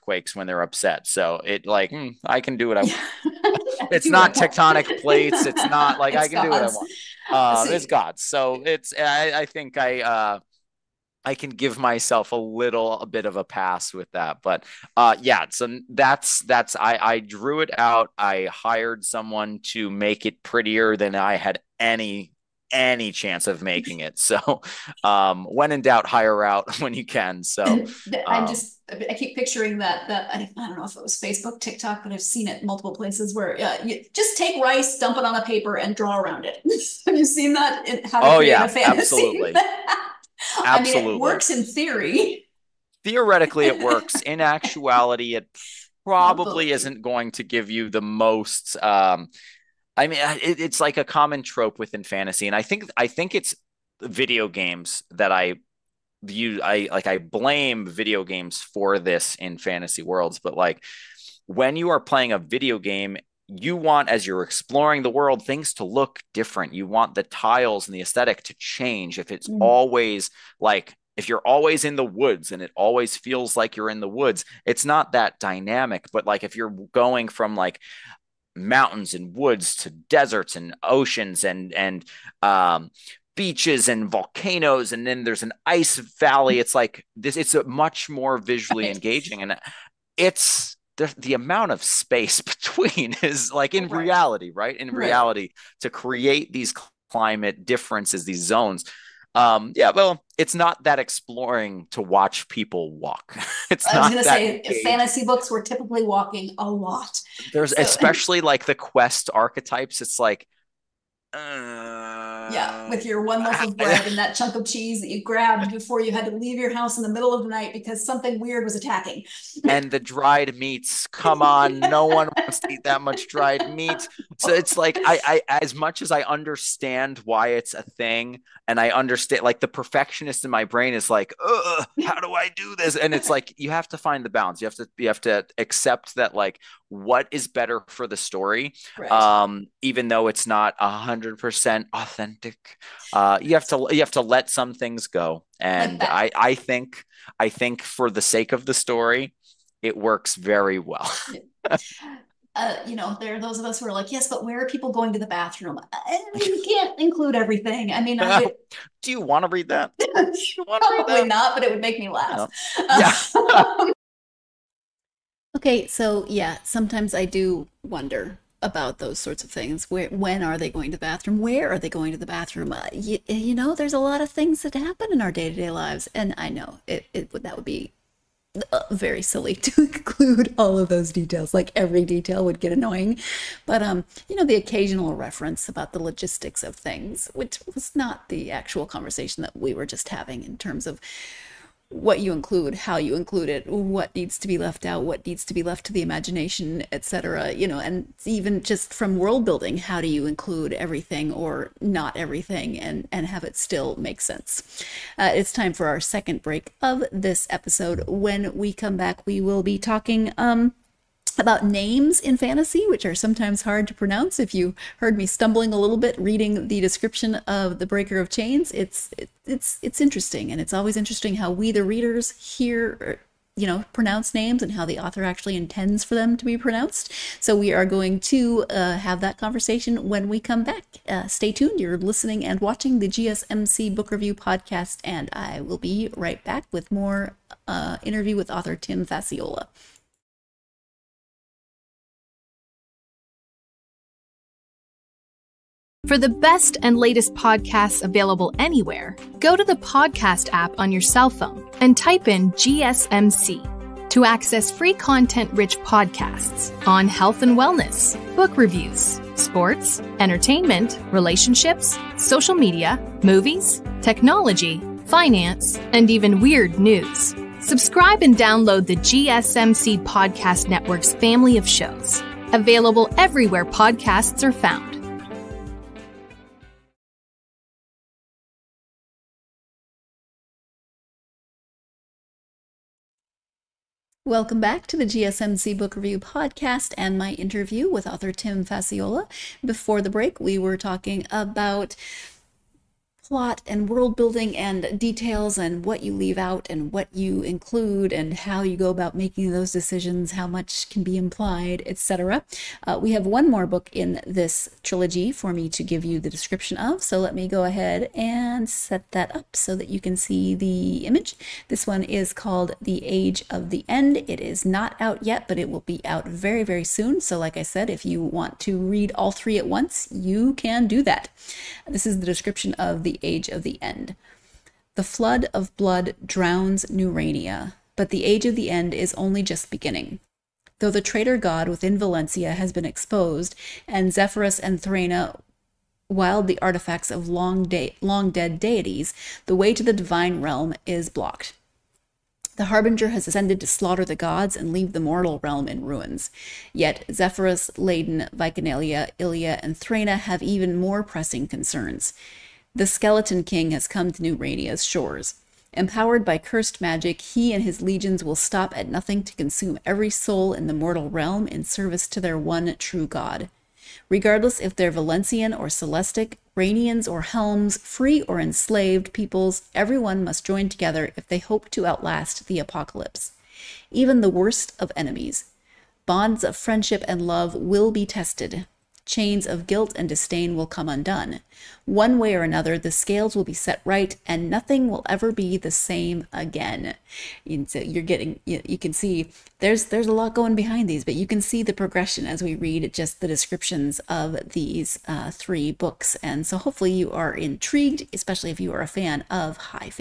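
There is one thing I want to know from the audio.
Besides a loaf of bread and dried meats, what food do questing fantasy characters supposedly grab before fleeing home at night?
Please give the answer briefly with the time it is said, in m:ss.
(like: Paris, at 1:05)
chunk of cheese, at 1:54.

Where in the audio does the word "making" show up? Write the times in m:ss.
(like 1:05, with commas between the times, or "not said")
0:23, 4:59.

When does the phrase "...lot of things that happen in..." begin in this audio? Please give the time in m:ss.
2:53.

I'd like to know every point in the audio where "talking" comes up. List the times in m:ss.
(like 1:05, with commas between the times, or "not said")
3:29, 4:50.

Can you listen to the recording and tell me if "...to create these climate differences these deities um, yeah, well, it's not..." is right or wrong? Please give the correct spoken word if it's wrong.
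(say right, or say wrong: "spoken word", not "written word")
wrong: "zones", not "deities".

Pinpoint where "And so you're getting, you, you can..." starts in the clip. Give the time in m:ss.
6:27.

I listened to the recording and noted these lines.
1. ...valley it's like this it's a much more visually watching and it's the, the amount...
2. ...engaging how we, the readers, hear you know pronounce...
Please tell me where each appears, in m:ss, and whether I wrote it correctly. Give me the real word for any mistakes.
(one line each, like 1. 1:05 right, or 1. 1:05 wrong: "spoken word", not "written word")
1. 1:26 wrong: "engaging", not "watching"
2. 3:40 wrong: "interesting", not "engaging".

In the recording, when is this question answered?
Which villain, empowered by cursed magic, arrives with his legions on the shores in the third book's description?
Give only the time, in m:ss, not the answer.
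5:52.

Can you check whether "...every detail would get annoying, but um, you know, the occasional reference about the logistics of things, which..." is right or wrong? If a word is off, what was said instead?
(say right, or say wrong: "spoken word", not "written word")
right.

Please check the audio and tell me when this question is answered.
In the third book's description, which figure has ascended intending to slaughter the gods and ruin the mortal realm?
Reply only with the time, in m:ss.
5:42.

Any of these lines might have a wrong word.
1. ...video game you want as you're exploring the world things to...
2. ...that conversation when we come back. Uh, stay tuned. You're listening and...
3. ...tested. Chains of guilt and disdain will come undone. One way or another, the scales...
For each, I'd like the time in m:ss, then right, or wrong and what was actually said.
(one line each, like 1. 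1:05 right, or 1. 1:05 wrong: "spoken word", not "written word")
1. 1:02 right
2. 3:49 right
3. 6:18 right.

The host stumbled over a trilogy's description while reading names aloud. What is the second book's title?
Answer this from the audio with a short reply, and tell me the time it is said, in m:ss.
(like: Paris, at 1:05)
The Breaker of Chains, at 3:37.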